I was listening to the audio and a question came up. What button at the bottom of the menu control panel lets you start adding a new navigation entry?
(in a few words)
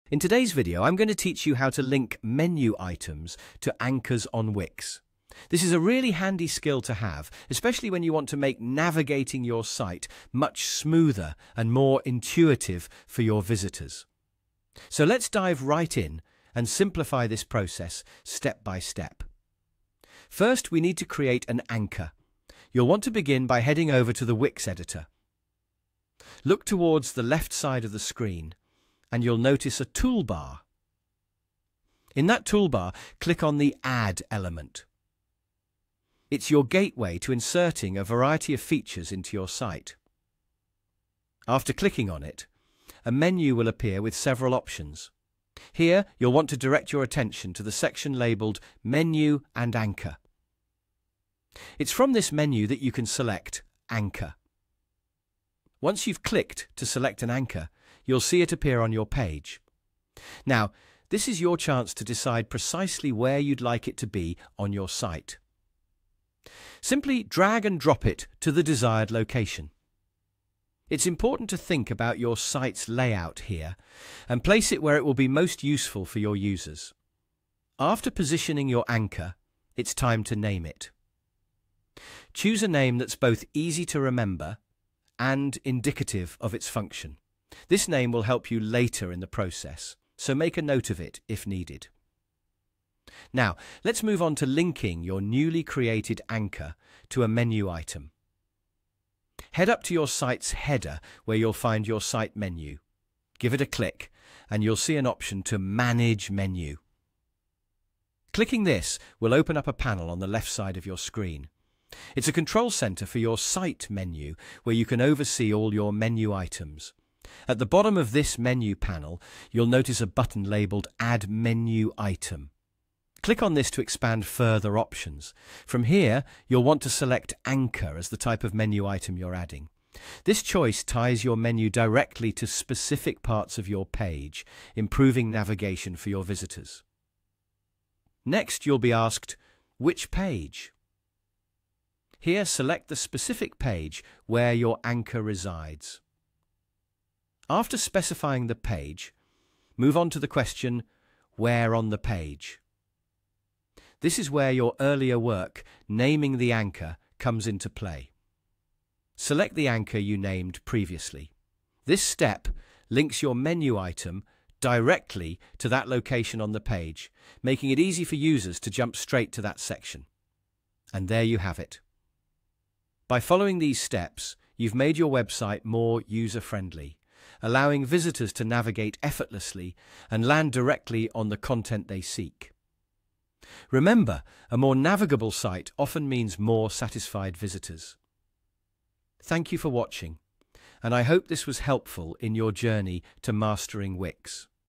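Add Menu Item.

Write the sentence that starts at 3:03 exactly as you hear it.
Remember, a more navigable site often means more satisfied visitors.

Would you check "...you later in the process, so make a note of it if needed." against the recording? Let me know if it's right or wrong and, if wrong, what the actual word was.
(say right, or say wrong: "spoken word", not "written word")
right.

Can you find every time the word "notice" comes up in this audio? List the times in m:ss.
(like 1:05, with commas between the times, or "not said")
0:29, 1:59.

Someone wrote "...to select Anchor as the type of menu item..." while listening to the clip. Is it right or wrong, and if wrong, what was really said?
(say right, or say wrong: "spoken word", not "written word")
right.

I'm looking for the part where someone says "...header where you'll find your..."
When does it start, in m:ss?
1:40.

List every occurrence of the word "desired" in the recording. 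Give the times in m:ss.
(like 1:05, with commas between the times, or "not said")
1:08.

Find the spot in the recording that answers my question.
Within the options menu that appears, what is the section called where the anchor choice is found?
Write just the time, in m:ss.
0:48.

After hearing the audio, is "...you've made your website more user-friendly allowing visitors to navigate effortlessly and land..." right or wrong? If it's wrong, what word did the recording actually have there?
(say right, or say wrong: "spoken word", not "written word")
right.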